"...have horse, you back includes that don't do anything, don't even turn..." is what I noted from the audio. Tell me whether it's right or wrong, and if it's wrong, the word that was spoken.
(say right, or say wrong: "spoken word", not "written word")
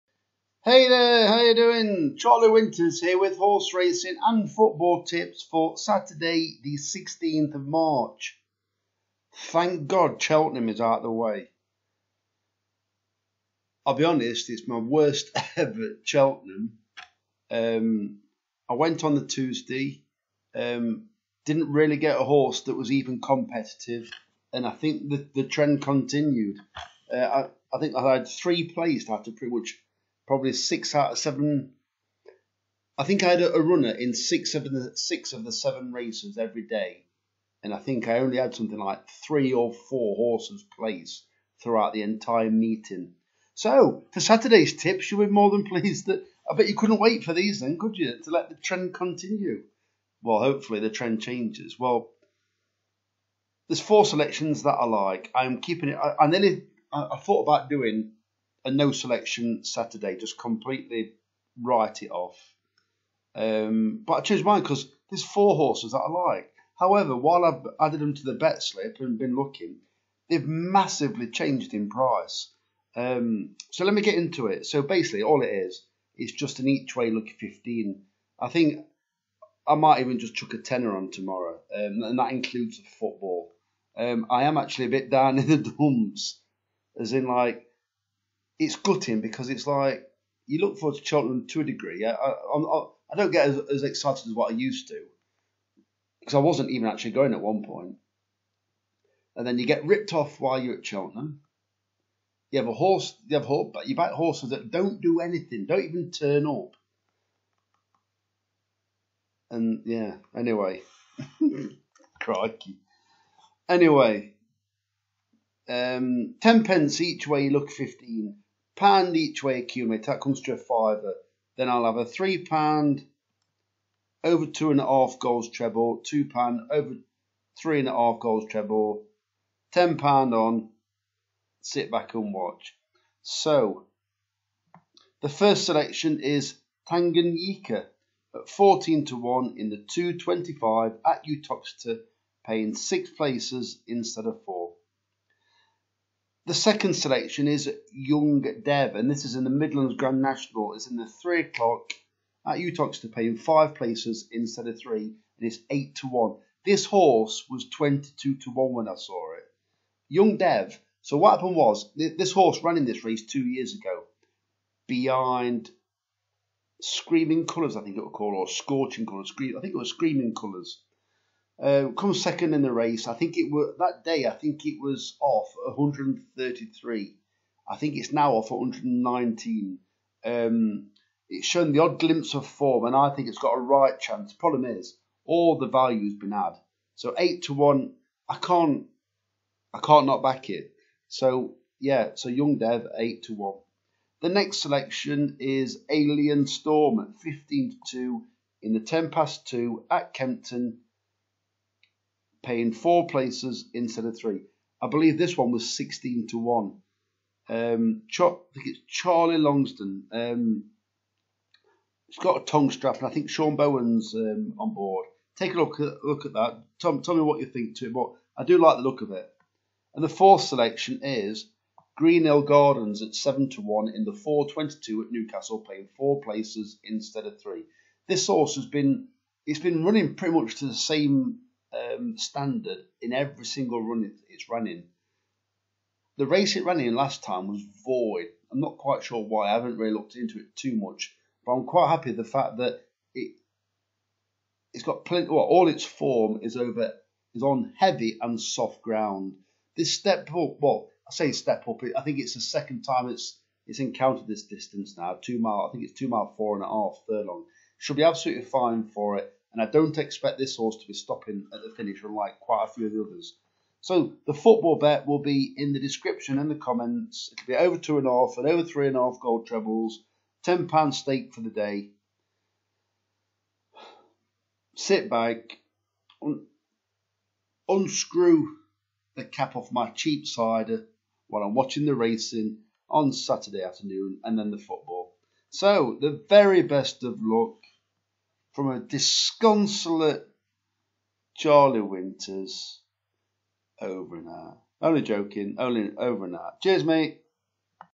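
wrong: "horses", not "includes".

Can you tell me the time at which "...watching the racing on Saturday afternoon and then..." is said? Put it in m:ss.
4:41.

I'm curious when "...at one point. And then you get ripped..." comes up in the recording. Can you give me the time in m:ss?
1:37.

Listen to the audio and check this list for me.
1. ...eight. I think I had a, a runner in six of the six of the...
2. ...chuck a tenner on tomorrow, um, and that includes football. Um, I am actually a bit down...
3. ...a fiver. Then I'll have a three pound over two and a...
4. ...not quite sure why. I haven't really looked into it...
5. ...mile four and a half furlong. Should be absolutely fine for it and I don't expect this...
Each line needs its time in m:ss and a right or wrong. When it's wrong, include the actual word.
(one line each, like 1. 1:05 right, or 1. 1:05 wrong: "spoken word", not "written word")
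1. 0:31 wrong: "seven", not "eight"
2. 1:20 right
3. 2:00 right
4. 3:58 right
5. 4:16 right.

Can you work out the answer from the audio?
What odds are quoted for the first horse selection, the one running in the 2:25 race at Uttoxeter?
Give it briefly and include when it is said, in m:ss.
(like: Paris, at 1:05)
14 to 1, at 2:18.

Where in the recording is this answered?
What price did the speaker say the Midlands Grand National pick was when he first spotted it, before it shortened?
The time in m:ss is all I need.
2:37.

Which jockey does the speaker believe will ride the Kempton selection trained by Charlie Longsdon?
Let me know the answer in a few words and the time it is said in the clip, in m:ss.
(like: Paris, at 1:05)
Sean Bowen, at 3:33.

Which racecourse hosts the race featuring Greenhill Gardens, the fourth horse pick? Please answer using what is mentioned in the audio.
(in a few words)
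Newcastle.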